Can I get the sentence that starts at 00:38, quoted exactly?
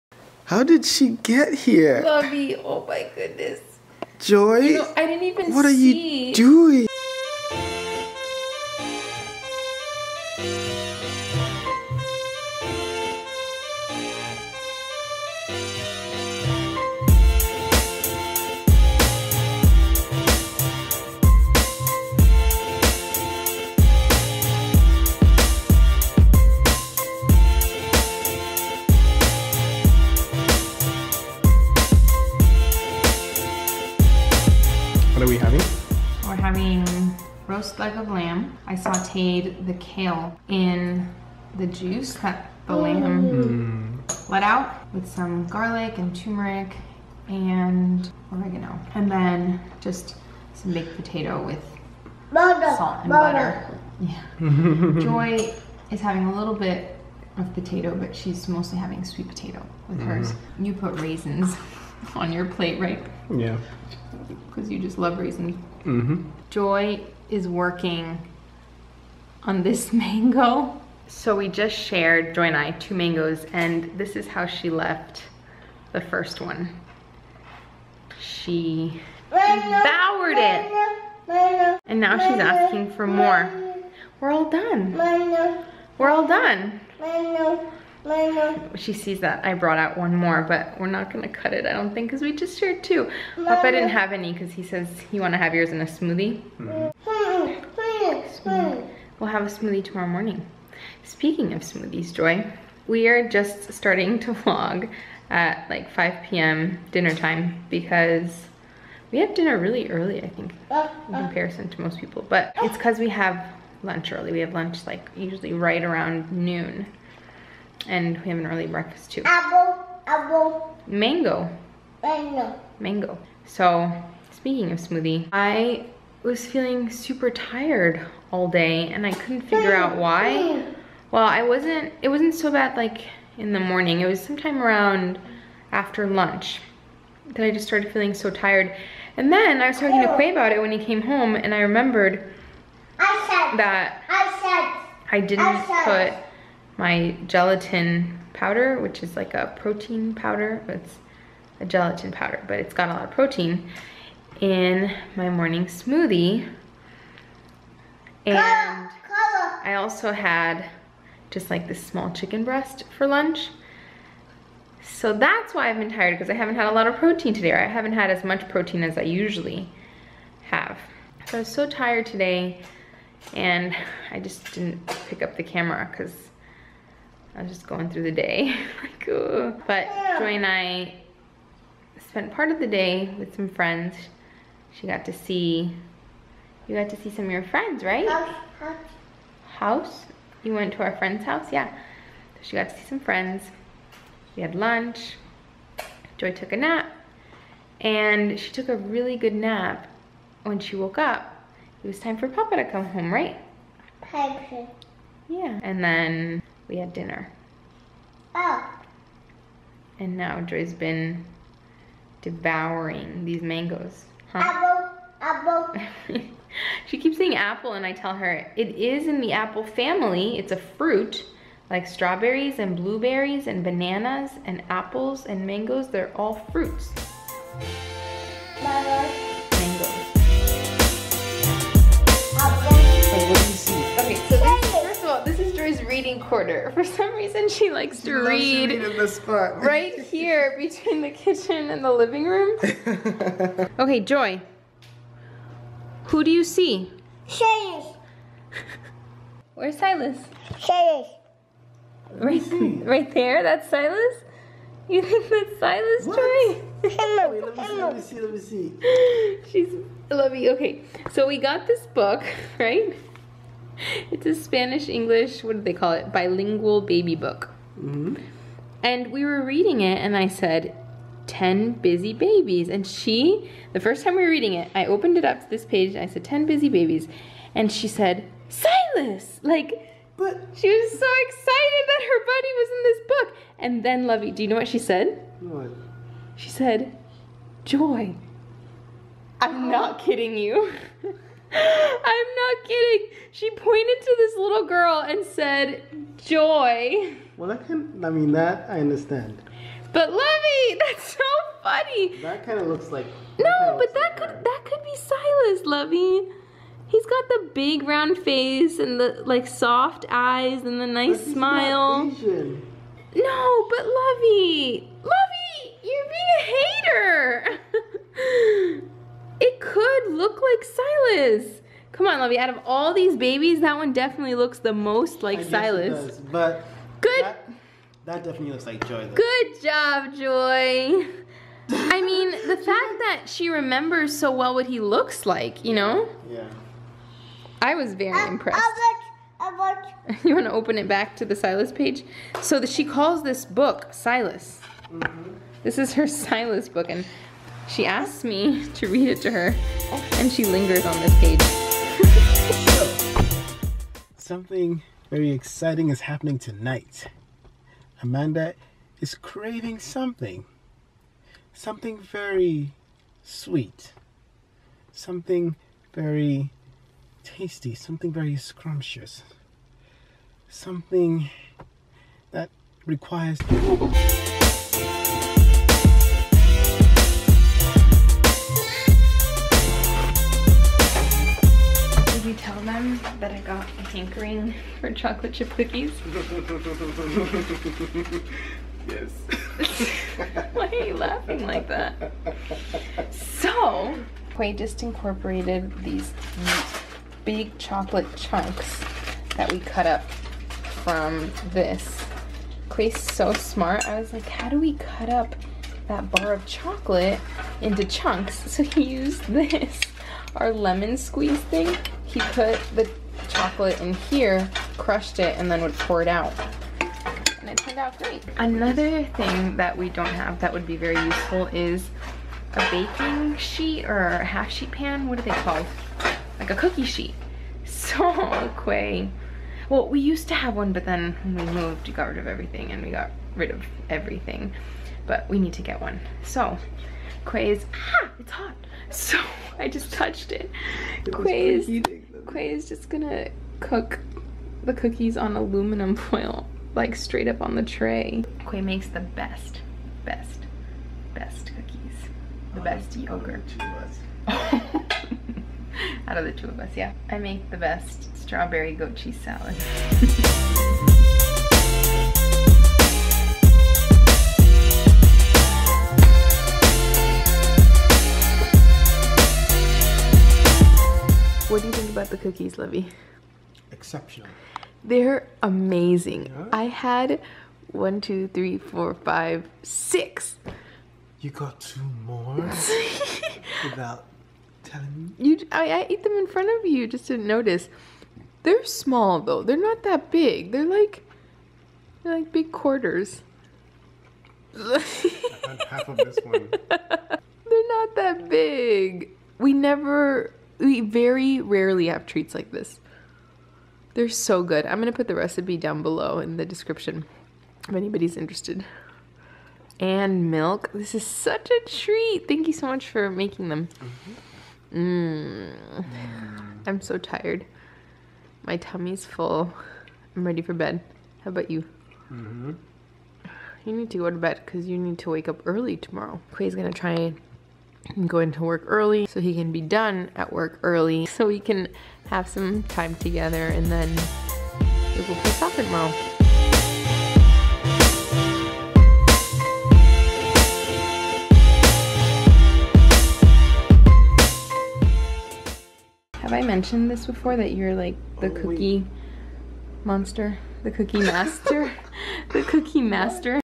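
I sauteed the kale in the juice that the oh.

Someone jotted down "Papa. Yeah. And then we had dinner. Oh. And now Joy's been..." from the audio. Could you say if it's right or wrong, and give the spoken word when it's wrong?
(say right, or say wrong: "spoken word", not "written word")
right.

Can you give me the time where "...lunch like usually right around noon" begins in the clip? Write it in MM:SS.
01:54.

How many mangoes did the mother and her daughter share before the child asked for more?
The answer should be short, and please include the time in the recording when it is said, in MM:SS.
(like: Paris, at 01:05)
2, at 01:12.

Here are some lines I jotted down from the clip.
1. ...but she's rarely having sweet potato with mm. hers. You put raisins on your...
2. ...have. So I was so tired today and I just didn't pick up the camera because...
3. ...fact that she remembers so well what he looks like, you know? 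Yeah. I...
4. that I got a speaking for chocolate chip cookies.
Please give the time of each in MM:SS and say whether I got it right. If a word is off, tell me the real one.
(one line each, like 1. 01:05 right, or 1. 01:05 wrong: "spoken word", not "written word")
1. 00:57 wrong: "mostly", not "rarely"
2. 02:50 right
3. 05:32 right
4. 06:23 wrong: "hankering", not "speaking".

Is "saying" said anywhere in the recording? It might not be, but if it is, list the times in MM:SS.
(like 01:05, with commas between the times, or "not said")
03:37.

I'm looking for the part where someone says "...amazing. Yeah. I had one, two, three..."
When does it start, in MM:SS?
07:55.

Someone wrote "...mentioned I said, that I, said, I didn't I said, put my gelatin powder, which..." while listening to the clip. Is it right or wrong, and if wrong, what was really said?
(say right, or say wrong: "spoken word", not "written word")
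wrong: "remembered", not "mentioned".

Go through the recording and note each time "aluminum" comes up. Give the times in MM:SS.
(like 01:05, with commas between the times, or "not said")
07:25.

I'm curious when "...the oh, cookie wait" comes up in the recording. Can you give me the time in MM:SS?
09:08.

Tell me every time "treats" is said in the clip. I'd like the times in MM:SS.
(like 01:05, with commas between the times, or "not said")
08:22, 08:31.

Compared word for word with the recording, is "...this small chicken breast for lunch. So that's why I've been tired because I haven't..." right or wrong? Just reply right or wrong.
right.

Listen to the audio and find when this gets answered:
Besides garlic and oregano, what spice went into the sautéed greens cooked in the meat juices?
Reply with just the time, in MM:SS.
00:46.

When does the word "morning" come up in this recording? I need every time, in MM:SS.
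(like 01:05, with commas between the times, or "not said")
01:40, 02:13, 02:35.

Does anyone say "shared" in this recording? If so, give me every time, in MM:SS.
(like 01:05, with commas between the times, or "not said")
01:11, 01:32.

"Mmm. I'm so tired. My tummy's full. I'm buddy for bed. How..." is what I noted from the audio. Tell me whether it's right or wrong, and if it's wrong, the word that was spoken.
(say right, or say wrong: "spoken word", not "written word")
wrong: "ready", not "buddy".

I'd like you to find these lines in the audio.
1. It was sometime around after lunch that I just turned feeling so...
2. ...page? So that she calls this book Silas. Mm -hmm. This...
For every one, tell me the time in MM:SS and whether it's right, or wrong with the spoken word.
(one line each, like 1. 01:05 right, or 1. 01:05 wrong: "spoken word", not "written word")
1. 02:14 wrong: "started", not "turned"
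2. 05:41 right.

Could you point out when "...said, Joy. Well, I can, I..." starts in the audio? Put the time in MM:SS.
04:55.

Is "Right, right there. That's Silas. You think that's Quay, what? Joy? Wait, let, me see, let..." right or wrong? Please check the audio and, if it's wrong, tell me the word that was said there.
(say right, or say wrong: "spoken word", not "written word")
wrong: "Silas", not "Quay".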